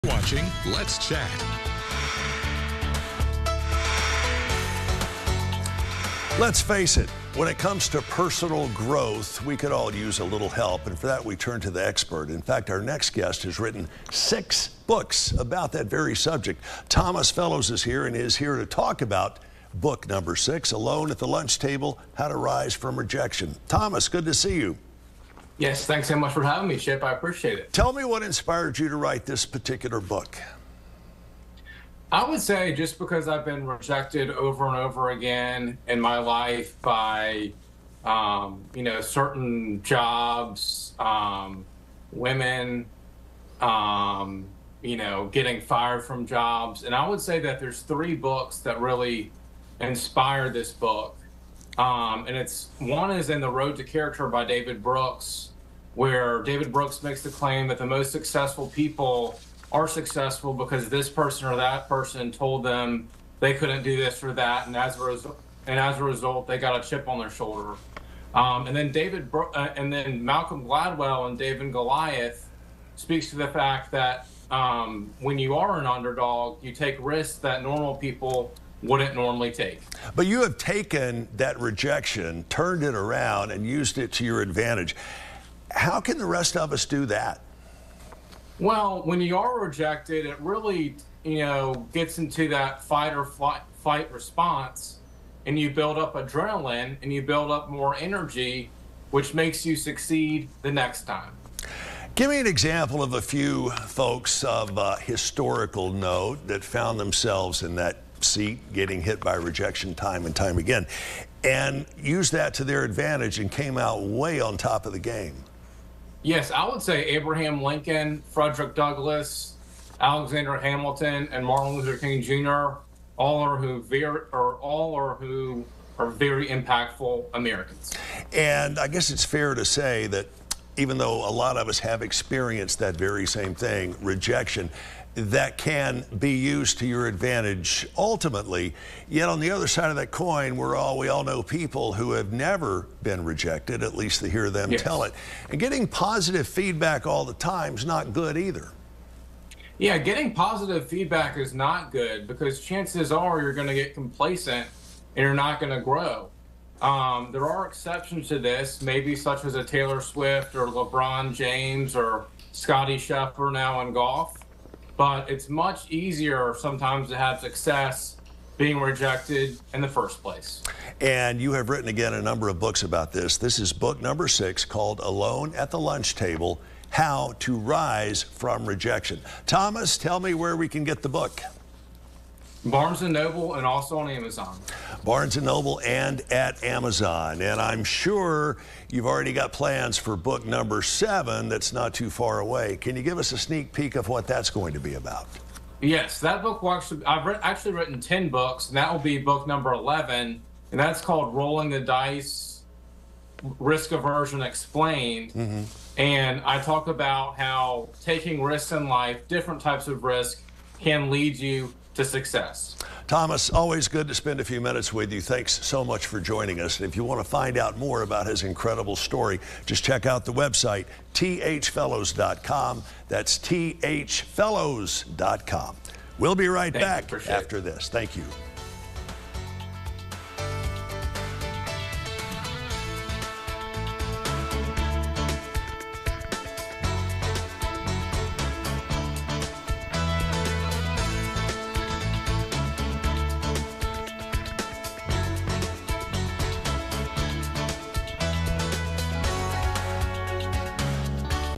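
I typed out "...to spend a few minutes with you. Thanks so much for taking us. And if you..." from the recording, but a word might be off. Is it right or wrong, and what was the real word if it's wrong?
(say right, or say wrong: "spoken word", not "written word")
wrong: "joining", not "taking".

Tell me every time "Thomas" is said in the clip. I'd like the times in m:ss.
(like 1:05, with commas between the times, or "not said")
0:16, 0:23, 2:59, 3:33.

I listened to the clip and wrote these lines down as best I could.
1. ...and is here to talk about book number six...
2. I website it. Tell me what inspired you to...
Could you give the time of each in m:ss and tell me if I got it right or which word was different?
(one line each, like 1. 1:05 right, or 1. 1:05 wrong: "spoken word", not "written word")
1. 0:18 right
2. 0:27 wrong: "appreciate", not "website".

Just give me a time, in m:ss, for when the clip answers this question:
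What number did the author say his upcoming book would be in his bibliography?
3:19.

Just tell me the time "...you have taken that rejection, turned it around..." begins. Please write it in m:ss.
1:20.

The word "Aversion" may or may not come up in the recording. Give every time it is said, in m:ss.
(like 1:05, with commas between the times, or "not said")
3:23.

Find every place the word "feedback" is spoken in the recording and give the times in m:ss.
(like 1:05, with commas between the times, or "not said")
2:26, 2:30.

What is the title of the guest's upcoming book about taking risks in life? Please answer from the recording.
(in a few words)
Rolling the Dice.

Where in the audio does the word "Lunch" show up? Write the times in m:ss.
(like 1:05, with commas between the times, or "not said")
0:21, 2:55.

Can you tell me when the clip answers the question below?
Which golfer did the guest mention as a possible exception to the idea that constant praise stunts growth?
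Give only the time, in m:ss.
2:42.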